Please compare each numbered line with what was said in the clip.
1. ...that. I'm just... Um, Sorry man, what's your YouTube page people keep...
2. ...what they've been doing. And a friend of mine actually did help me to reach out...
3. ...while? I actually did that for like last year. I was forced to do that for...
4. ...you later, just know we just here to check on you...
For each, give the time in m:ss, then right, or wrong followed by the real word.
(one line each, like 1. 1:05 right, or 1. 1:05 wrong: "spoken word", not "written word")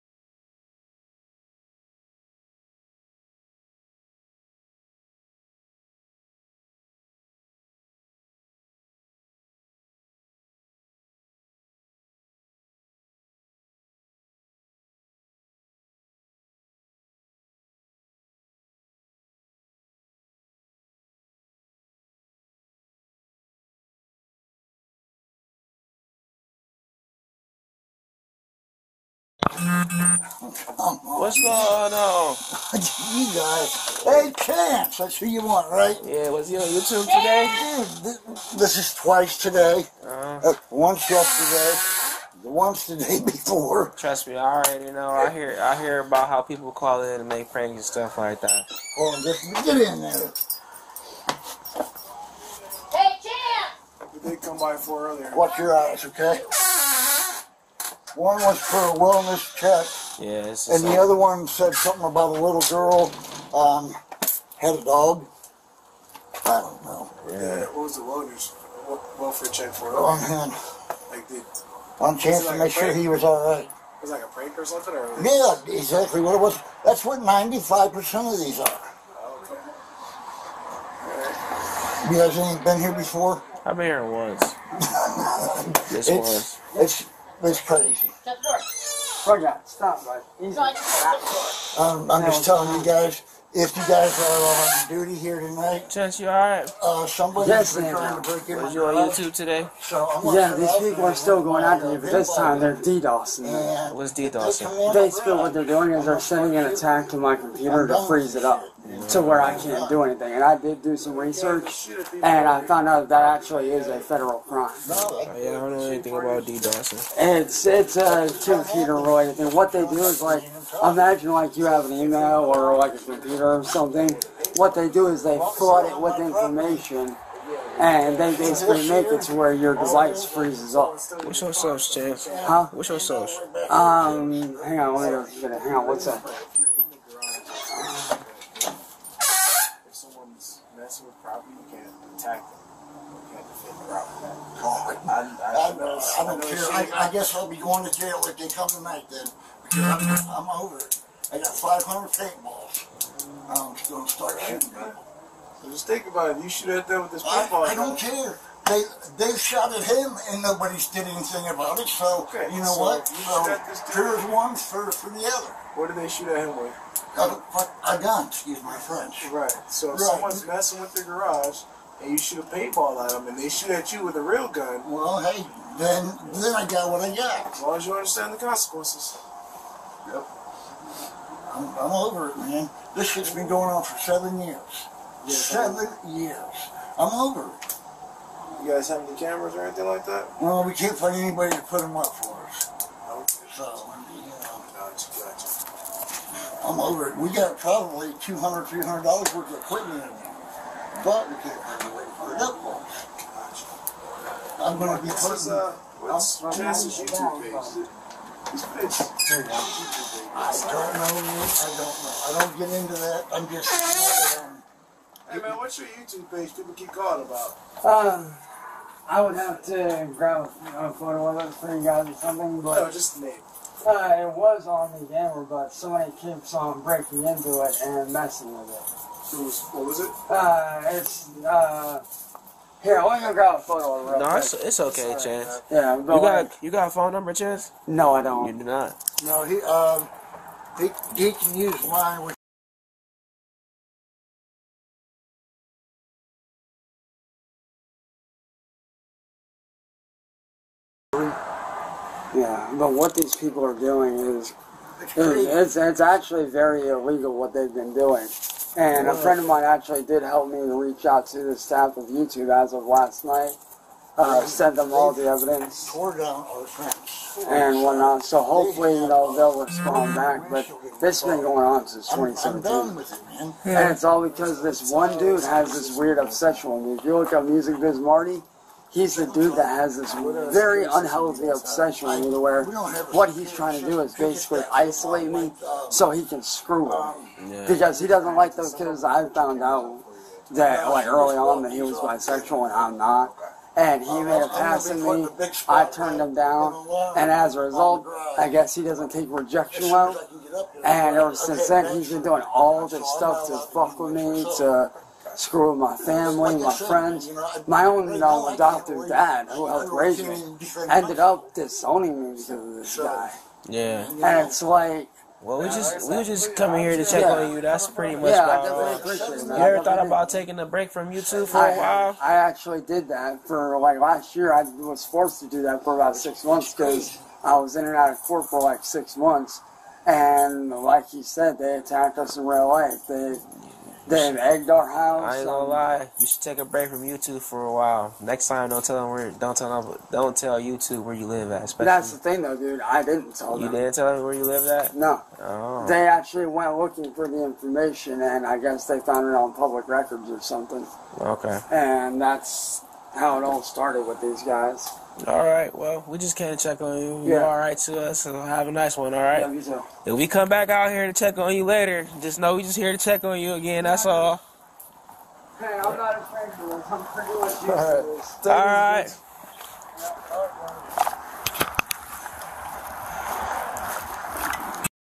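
1. 3:32 wrong: "Hey", not "Sorry"
2. 4:17 right
3. 5:21 right
4. 6:01 right.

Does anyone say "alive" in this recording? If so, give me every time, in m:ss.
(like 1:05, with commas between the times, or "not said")
not said.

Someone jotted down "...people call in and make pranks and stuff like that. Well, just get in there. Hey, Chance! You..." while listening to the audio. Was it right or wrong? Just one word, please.
right.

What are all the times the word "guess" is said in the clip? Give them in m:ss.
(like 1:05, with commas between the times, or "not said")
2:27, 4:58, 5:48.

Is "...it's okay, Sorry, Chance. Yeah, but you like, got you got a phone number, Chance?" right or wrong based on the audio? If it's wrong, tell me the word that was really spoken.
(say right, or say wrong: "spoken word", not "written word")
right.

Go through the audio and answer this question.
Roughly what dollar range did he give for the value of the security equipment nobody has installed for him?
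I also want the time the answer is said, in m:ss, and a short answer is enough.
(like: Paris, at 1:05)
$200-$300, at 3:18.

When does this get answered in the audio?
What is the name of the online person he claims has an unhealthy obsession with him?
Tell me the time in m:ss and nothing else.
4:37.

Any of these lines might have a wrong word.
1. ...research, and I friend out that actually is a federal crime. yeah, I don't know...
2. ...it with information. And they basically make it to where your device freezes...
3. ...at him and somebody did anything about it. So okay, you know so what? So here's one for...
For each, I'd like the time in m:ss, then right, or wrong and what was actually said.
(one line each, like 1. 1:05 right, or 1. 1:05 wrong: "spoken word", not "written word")
1. 1:51 wrong: "found", not "friend"
2. 2:05 right
3. 2:39 wrong: "nobody", not "somebody".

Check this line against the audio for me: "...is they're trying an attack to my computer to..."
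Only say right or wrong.
wrong.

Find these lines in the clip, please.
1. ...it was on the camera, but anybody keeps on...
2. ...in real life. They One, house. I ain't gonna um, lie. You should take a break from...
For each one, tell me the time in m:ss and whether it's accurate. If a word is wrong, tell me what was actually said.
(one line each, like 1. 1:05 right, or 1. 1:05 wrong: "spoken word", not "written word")
1. 3:44 wrong: "somebody", not "anybody"
2. 5:32 wrong: "Damn", not "One".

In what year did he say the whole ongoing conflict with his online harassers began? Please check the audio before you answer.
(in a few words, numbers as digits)
2017.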